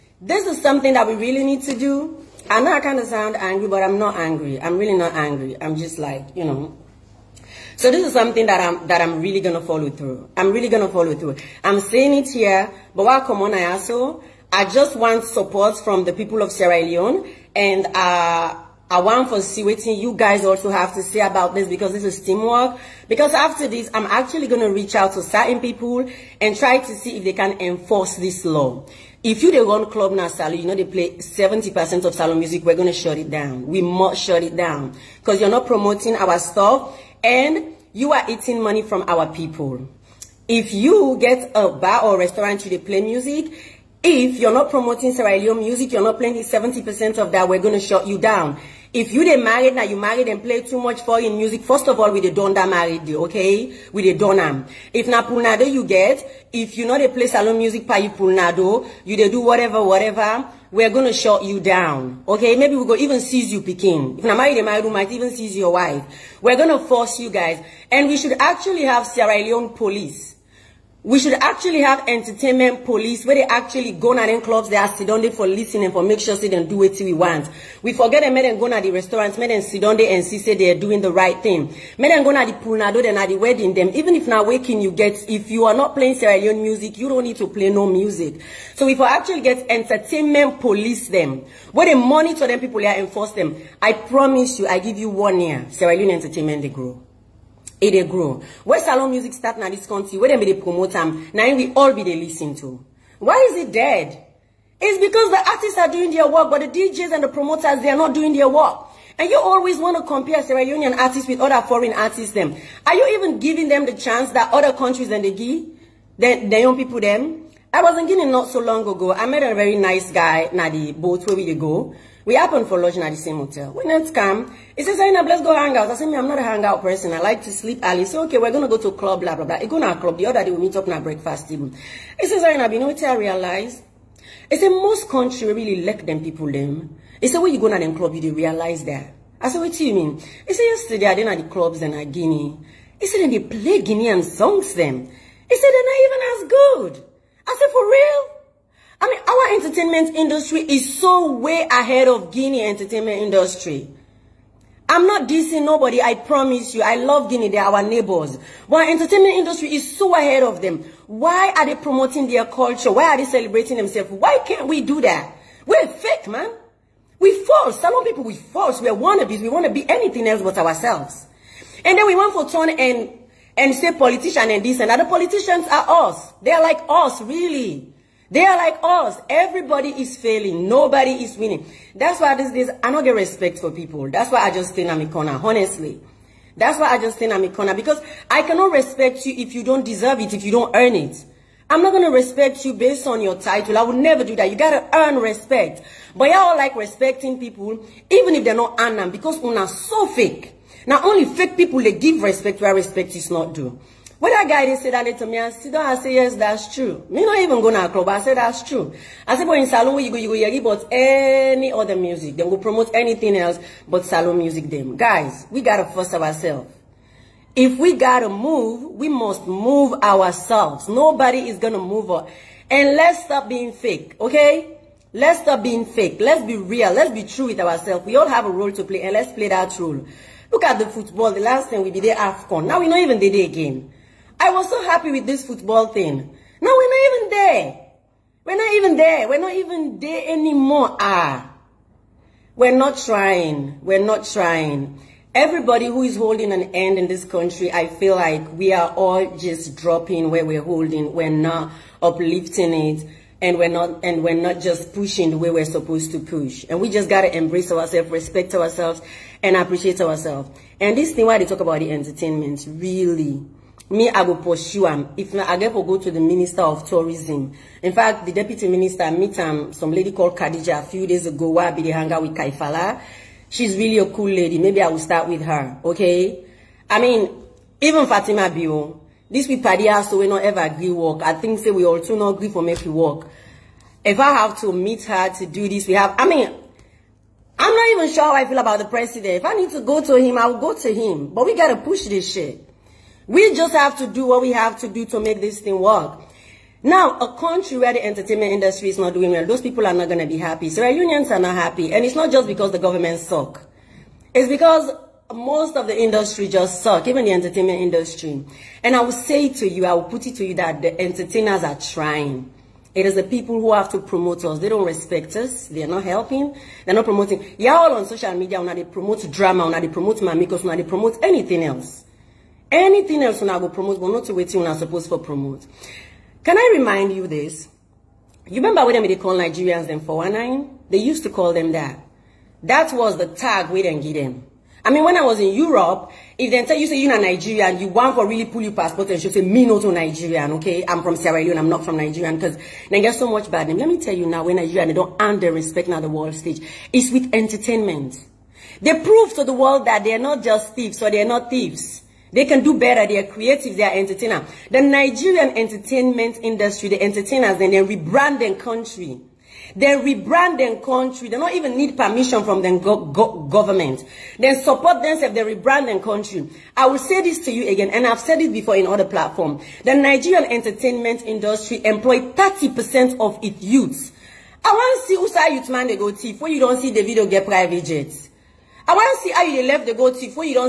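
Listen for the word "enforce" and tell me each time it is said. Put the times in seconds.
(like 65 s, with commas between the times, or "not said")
27 s, 92 s.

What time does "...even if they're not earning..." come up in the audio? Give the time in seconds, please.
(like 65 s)
198 s.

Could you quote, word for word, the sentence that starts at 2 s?
I know I kind of sound angry, but I'm not angry.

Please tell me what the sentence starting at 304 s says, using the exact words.
It's because most of the industry just suck, even the entertainment industry.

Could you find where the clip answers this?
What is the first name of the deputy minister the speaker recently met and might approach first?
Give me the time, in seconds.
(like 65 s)
270 s.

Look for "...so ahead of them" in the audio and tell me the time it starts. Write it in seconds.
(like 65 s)
159 s.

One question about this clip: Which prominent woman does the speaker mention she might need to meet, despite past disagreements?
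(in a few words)
Fatima Bio.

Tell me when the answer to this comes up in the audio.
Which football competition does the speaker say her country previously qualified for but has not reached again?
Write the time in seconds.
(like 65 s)
232 s.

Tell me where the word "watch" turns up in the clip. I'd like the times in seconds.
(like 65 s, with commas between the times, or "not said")
not said.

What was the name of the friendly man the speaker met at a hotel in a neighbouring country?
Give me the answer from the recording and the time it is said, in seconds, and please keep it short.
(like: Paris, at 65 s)
Nadi, at 120 s.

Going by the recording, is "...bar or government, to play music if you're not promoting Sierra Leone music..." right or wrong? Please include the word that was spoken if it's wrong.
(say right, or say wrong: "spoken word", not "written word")
wrong: "restaurant", not "government".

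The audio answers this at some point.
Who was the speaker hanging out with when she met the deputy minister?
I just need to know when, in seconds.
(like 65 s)
272 s.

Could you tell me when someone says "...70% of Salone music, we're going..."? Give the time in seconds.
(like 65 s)
31 s.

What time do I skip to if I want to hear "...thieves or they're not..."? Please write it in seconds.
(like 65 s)
350 s.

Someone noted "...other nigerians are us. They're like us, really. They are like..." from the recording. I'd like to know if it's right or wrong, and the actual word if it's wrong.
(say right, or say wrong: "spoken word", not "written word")
wrong: "politicians", not "nigerians".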